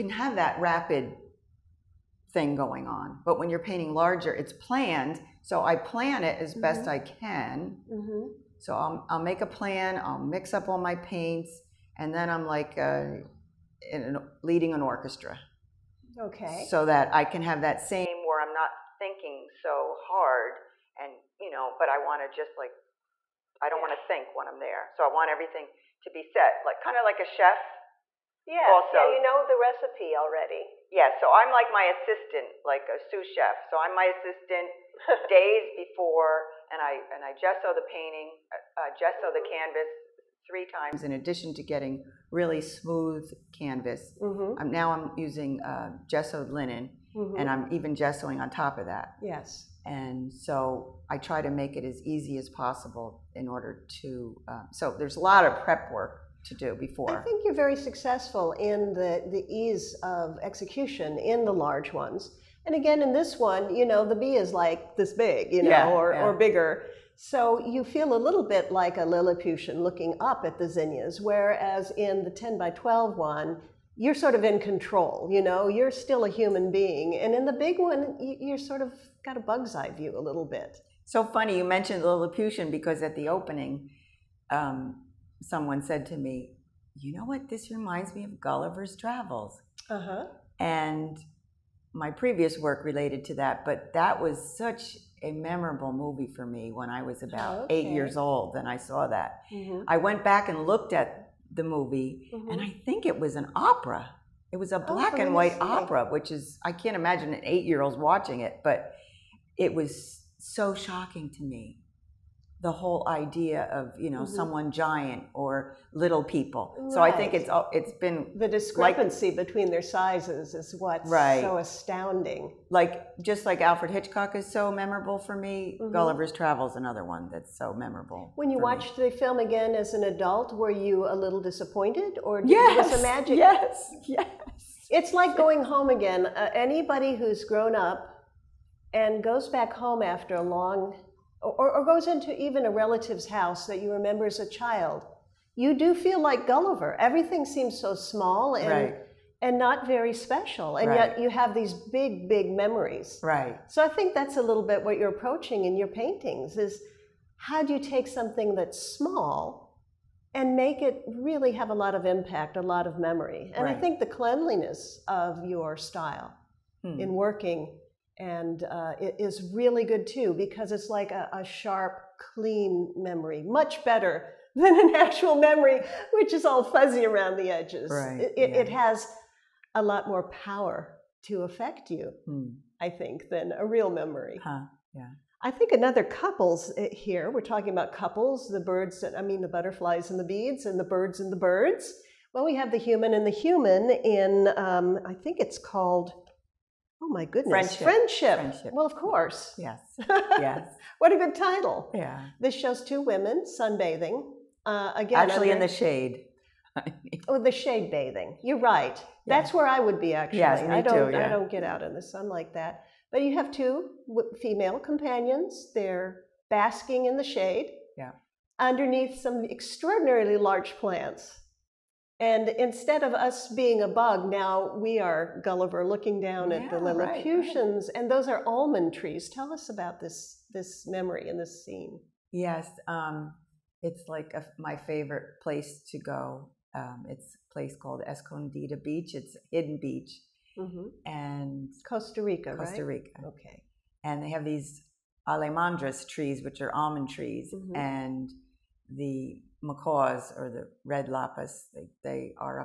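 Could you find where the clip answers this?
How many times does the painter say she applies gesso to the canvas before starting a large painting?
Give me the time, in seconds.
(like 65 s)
40 s.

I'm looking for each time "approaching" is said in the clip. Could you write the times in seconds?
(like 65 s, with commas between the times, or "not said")
155 s.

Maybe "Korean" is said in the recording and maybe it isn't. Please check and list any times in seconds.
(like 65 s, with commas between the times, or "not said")
not said.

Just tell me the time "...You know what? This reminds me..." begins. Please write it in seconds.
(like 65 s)
86 s.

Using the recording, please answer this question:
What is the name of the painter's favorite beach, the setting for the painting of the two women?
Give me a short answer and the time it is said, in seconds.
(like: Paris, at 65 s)
Escondida Beach, at 238 s.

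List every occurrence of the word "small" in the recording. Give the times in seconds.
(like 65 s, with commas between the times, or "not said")
147 s, 158 s.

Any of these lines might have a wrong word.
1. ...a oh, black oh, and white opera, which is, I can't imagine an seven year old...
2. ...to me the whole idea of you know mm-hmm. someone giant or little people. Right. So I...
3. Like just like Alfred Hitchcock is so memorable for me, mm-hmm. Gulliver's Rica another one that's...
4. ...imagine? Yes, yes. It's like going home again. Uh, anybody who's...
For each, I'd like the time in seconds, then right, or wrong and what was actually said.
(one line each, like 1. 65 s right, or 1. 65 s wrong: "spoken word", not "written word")
1. 104 s wrong: "eight", not "seven"
2. 111 s right
3. 122 s wrong: "Travels", not "Rica"
4. 132 s right.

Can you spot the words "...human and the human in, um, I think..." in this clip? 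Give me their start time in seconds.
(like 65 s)
192 s.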